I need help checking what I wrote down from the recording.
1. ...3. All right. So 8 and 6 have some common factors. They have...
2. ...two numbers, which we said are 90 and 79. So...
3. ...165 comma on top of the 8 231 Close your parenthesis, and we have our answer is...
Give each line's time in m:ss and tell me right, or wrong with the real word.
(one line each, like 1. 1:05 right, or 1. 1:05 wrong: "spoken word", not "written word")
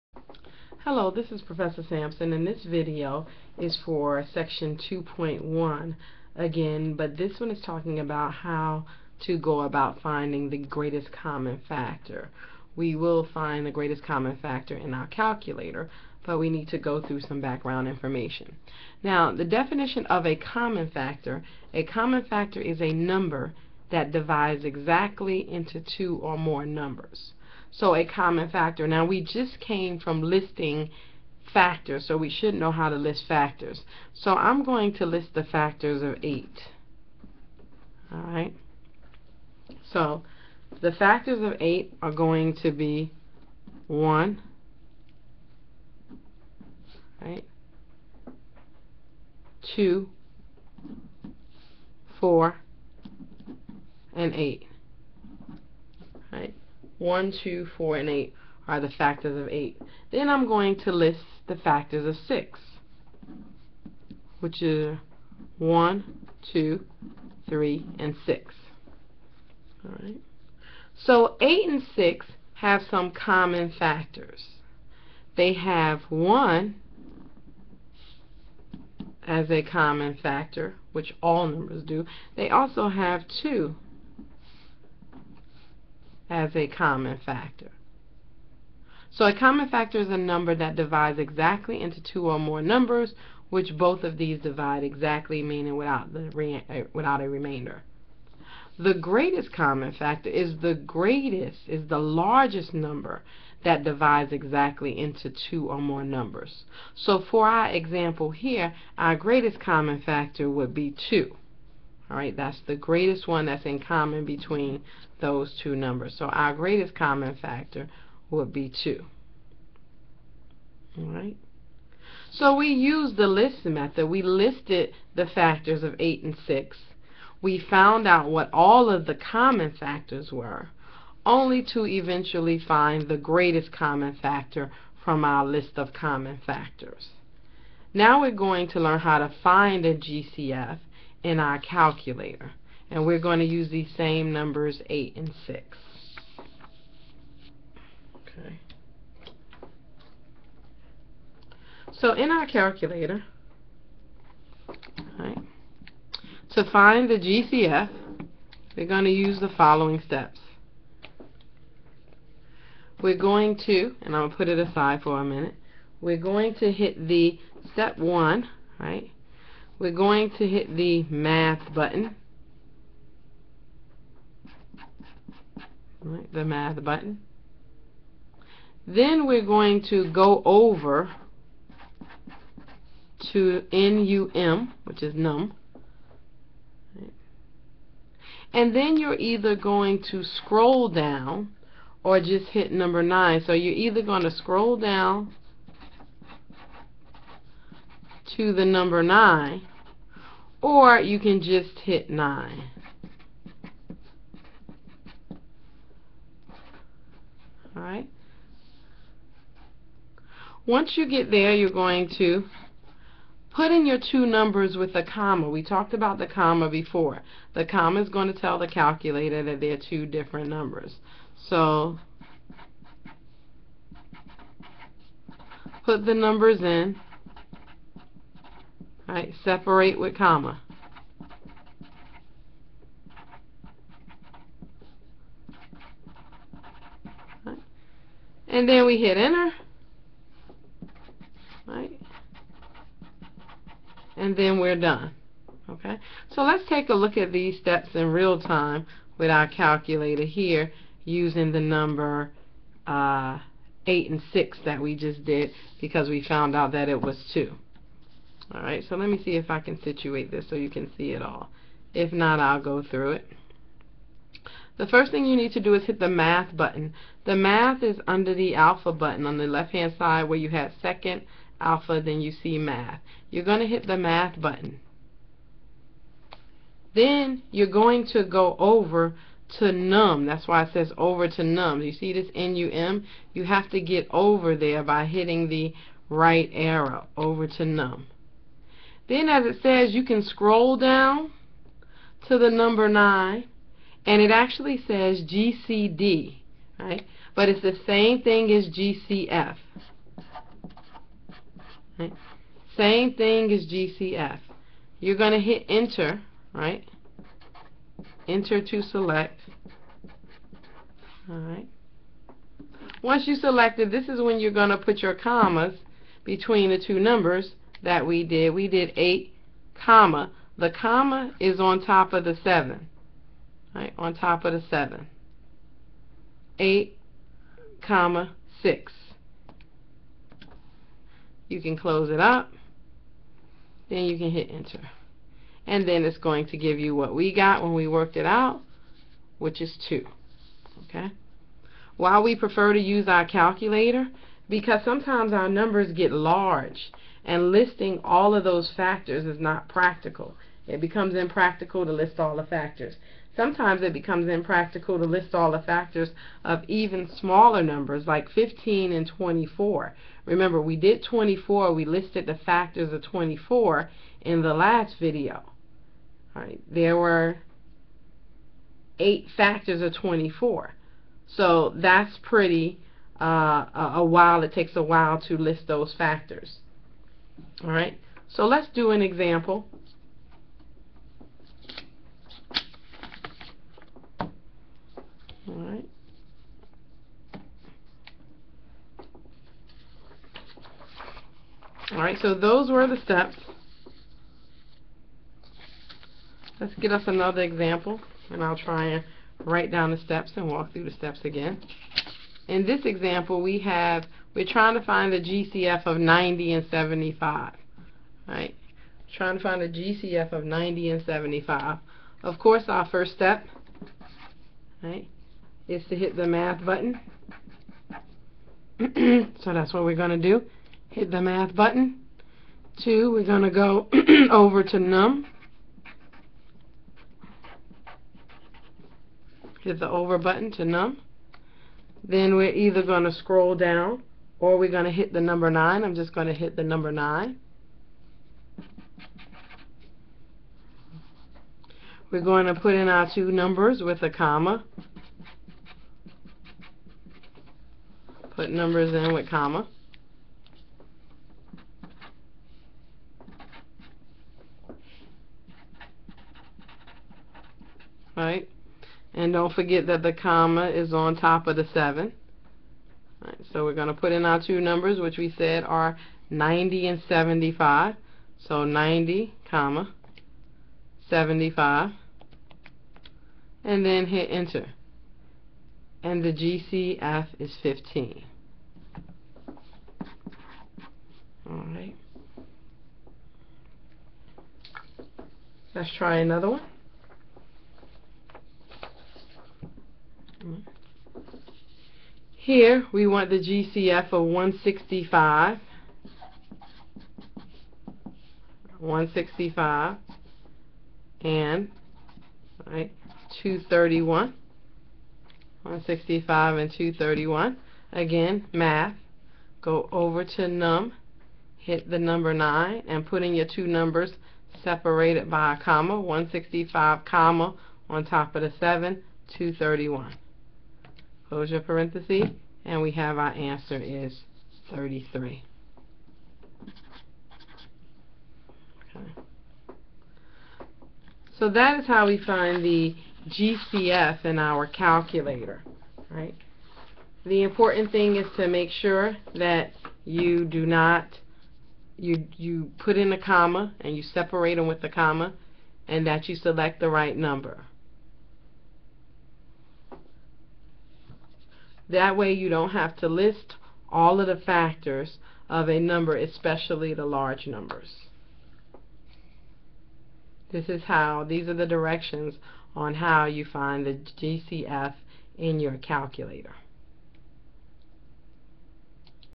1. 1:08 wrong: "6", not "3"
2. 7:44 wrong: "75", not "79"
3. 8:35 wrong: "7", not "8".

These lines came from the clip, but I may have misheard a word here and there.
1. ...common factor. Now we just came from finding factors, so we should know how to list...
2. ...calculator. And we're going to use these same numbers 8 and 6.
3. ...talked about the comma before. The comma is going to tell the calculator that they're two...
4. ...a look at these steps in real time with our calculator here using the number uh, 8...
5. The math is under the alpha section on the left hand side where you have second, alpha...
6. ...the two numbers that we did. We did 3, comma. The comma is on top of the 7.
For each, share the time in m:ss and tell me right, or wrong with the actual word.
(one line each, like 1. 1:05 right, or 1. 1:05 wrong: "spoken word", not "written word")
1. 0:28 wrong: "listing", not "finding"
2. 2:21 right
3. 3:35 right
4. 4:06 right
5. 4:27 wrong: "button", not "section"
6. 5:16 wrong: "8", not "3".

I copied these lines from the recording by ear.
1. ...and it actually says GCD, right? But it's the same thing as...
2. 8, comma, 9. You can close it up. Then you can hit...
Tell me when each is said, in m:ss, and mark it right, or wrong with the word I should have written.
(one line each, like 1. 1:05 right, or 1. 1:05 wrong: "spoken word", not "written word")
1. 4:54 right
2. 5:26 wrong: "6", not "9".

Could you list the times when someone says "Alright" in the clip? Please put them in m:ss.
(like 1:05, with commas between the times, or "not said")
0:38, 3:27, 4:18, 8:01.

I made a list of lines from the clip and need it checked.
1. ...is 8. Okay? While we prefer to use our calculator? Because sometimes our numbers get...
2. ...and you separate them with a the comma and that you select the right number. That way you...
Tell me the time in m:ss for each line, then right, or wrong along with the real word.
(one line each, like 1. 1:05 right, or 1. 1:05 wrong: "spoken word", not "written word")
1. 5:39 wrong: "2", not "8"
2. 9:03 right.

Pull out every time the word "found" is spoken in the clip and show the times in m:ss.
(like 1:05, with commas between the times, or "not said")
2:07, 4:16.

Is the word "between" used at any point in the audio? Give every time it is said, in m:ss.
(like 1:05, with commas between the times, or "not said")
1:54, 5:16.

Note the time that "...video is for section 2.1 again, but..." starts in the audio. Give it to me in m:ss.
0:02.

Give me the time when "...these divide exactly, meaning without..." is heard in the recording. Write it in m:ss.
1:34.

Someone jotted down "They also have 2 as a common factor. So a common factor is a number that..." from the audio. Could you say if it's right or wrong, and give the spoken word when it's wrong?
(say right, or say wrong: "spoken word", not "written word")
right.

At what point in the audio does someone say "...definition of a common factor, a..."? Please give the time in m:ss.
0:19.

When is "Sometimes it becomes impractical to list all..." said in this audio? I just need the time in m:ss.
5:53.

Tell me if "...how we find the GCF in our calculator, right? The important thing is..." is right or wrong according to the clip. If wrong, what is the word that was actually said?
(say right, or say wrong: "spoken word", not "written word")
right.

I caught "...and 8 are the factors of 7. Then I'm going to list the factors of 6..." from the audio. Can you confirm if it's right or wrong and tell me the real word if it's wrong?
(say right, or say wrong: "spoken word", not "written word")
wrong: "8", not "7".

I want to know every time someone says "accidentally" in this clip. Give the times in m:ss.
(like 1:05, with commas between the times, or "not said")
not said.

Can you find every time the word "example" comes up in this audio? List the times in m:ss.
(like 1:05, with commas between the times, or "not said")
1:47, 6:19, 6:37, 6:42.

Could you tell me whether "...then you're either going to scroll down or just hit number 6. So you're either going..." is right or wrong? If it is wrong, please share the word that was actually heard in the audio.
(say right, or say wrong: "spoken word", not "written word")
wrong: "9", not "6".